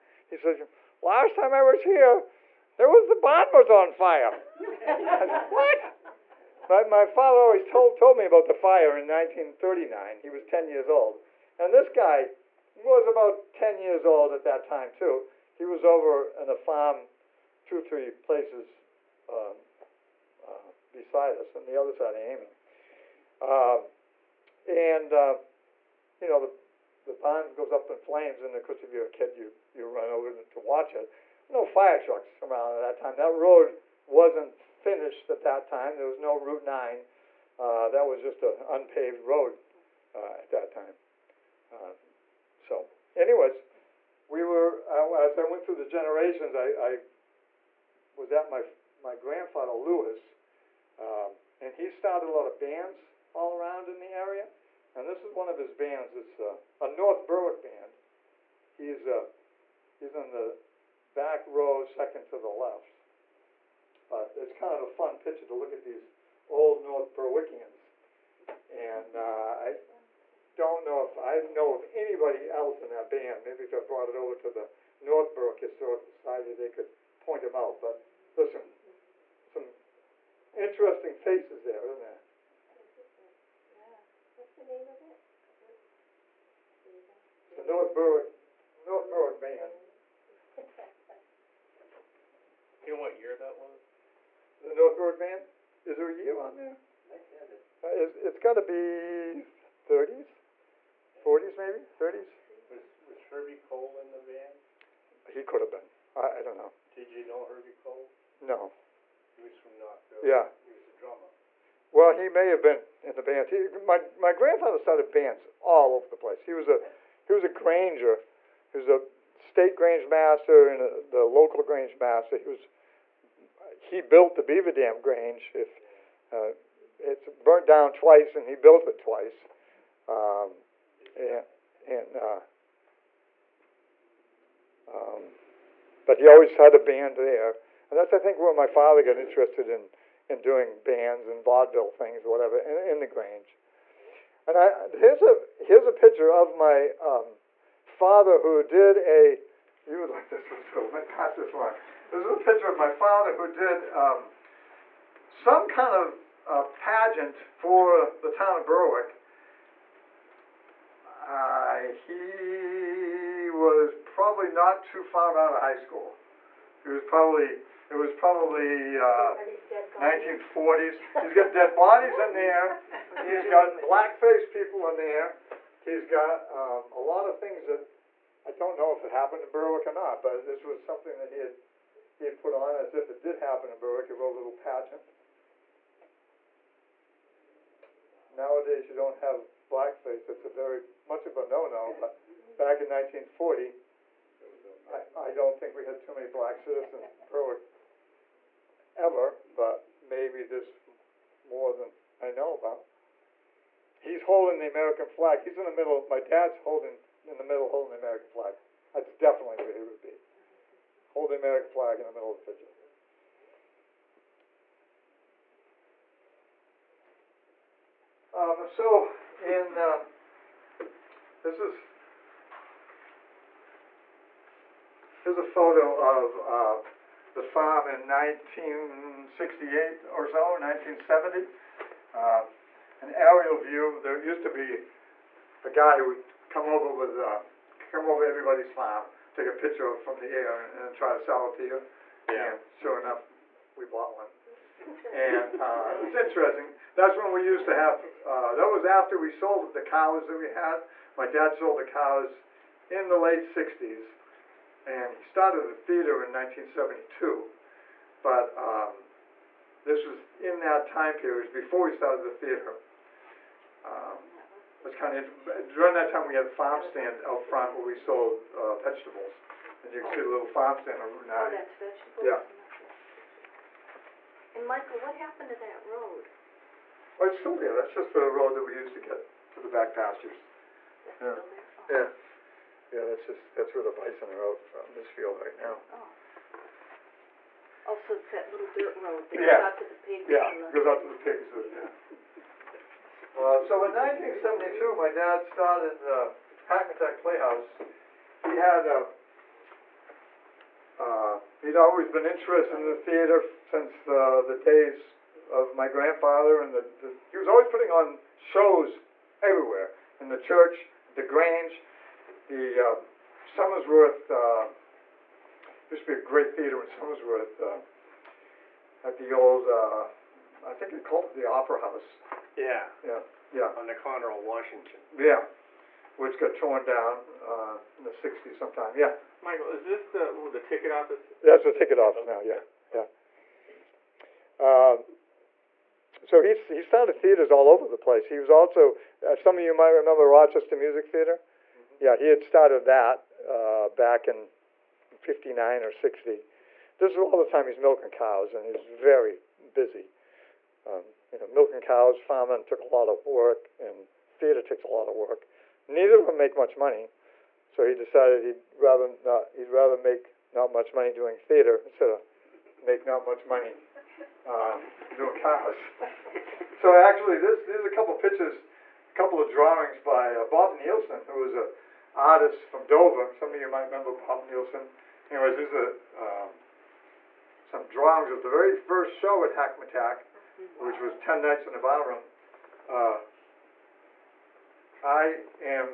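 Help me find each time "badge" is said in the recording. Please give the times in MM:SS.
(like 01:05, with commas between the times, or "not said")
not said.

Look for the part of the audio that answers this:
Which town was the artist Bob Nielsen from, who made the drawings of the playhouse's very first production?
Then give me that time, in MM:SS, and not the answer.
06:12.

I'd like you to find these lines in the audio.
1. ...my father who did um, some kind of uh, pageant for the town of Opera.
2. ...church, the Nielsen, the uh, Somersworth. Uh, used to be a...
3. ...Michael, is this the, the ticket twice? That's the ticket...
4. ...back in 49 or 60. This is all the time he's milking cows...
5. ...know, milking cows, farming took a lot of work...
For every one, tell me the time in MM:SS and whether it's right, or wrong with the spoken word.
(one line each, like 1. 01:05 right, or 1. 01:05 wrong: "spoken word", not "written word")
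1. 02:32 wrong: "Berwick", not "Opera"
2. 05:10 wrong: "Grange", not "Nielsen"
3. 05:29 wrong: "office", not "twice"
4. 05:43 wrong: "59", not "49"
5. 05:51 right.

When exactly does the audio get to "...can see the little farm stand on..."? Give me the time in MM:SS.
04:30.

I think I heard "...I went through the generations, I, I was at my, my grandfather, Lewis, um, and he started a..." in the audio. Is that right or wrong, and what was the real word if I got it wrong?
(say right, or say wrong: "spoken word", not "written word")
right.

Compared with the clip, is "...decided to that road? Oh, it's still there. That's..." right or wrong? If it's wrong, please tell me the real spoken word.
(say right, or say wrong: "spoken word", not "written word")
wrong: "happened", not "decided".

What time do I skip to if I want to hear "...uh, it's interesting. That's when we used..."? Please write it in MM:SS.
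04:05.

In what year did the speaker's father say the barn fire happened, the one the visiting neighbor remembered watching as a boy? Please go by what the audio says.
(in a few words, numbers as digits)
1939.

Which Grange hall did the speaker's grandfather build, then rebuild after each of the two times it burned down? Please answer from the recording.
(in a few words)
Beaver Dam Grange.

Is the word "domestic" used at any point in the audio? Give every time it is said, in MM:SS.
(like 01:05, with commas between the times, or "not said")
not said.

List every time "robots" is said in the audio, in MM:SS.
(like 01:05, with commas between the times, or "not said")
not said.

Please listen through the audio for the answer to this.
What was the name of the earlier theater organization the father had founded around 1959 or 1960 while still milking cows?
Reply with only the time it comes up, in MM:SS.
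05:40.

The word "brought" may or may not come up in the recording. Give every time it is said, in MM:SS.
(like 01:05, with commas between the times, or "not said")
01:13.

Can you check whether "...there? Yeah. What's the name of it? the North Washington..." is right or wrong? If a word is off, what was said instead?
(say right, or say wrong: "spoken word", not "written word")
wrong: "Berwick", not "Washington".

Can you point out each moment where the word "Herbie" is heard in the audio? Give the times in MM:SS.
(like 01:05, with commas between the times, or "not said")
01:43, 01:47.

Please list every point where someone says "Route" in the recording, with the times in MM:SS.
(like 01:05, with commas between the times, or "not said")
00:36, 04:31.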